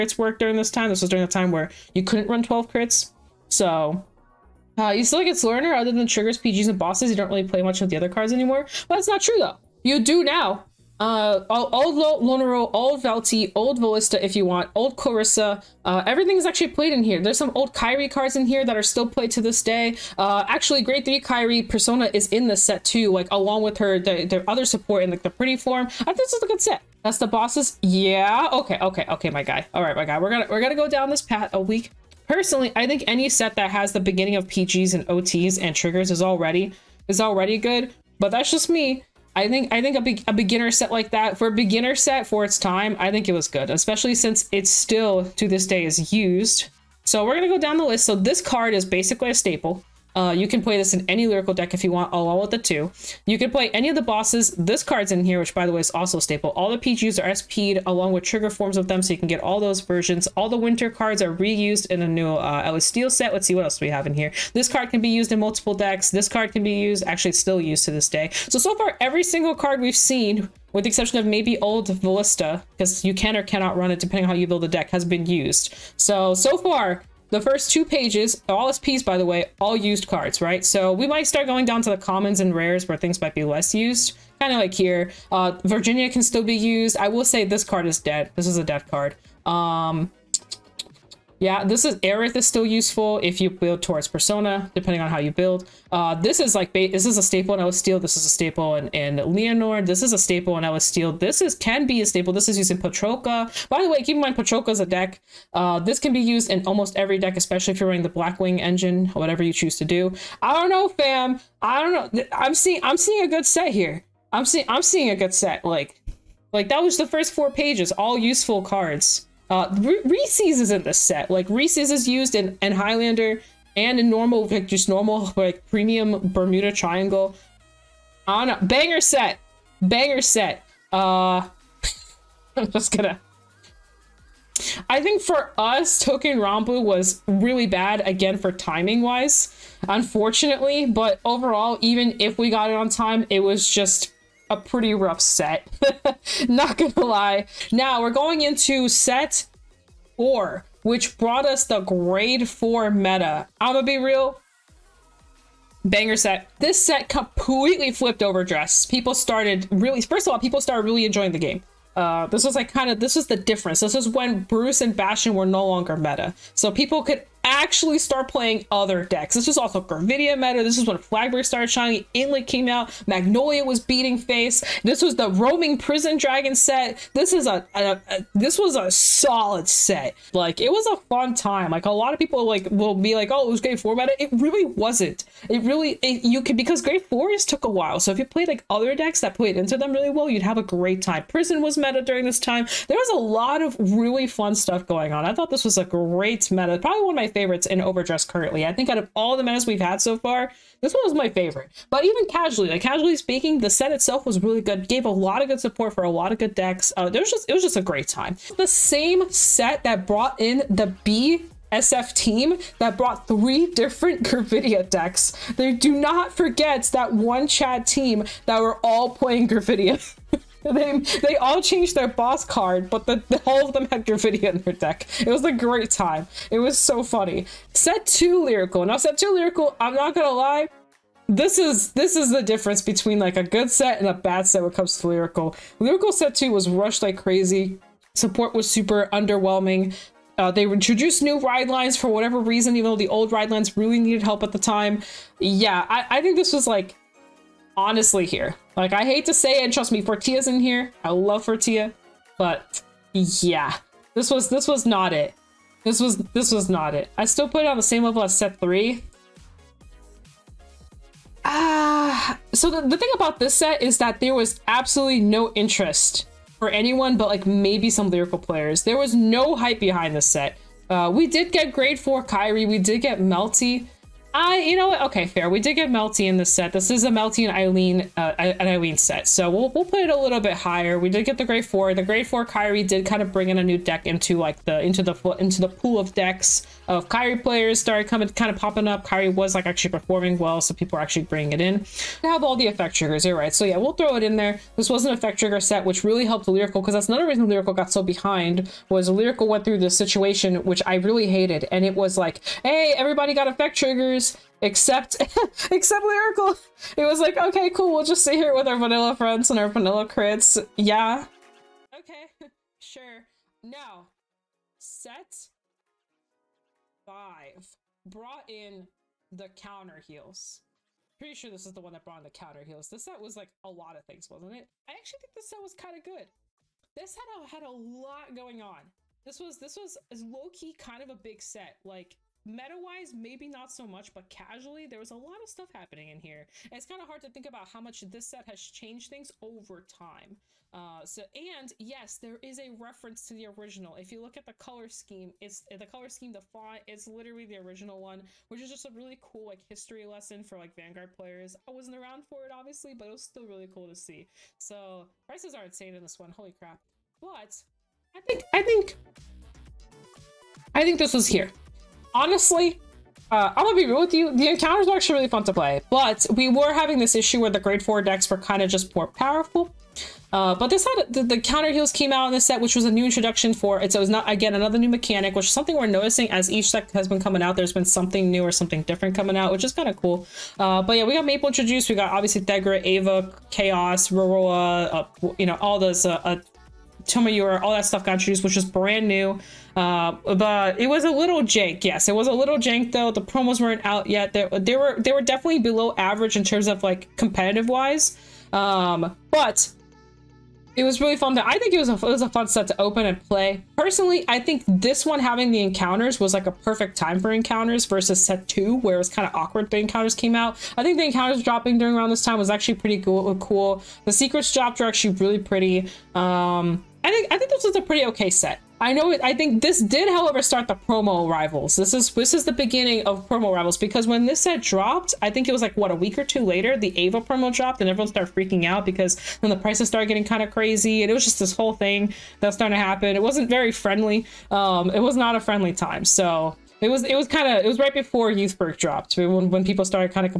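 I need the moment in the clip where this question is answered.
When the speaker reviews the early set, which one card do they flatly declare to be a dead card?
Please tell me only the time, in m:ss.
1:25.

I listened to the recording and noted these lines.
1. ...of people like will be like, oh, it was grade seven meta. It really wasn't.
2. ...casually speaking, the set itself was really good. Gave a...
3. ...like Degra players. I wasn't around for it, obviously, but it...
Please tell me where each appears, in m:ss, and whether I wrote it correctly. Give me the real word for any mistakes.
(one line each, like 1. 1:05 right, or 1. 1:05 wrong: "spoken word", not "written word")
1. 3:02 wrong: "four", not "seven"
2. 3:22 right
3. 5:50 wrong: "Vanguard", not "Degra".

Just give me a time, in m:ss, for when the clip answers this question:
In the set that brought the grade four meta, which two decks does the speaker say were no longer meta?
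2:44.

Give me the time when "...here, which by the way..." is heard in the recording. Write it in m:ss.
0:55.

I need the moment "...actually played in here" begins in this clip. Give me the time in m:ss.
0:16.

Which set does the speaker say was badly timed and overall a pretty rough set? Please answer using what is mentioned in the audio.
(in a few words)
Touken Ranbu.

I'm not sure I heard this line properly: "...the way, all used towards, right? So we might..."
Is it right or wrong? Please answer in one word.
wrong.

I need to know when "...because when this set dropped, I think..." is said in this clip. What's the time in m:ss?
7:03.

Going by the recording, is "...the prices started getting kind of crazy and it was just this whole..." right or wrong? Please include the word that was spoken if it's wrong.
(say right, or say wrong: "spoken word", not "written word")
right.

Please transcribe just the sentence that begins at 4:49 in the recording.
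Kyrie was like actually performing well, so people are actually bringing it in.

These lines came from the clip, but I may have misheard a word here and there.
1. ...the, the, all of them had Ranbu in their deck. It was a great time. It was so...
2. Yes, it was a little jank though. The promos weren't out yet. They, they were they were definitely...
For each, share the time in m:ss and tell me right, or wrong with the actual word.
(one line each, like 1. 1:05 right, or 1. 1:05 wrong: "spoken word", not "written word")
1. 3:43 wrong: "Gravidia", not "Ranbu"
2. 6:31 right.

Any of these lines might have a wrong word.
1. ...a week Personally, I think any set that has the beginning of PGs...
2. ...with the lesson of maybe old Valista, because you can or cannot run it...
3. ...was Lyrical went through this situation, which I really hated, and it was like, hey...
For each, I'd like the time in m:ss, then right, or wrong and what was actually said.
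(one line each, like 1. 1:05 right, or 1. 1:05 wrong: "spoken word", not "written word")
1. 0:31 right
2. 1:10 wrong: "exception", not "lesson"
3. 4:58 right.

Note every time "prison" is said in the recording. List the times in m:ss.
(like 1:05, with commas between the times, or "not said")
2:55, 3:11.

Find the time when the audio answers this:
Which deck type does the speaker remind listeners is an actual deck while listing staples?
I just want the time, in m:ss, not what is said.
1:44.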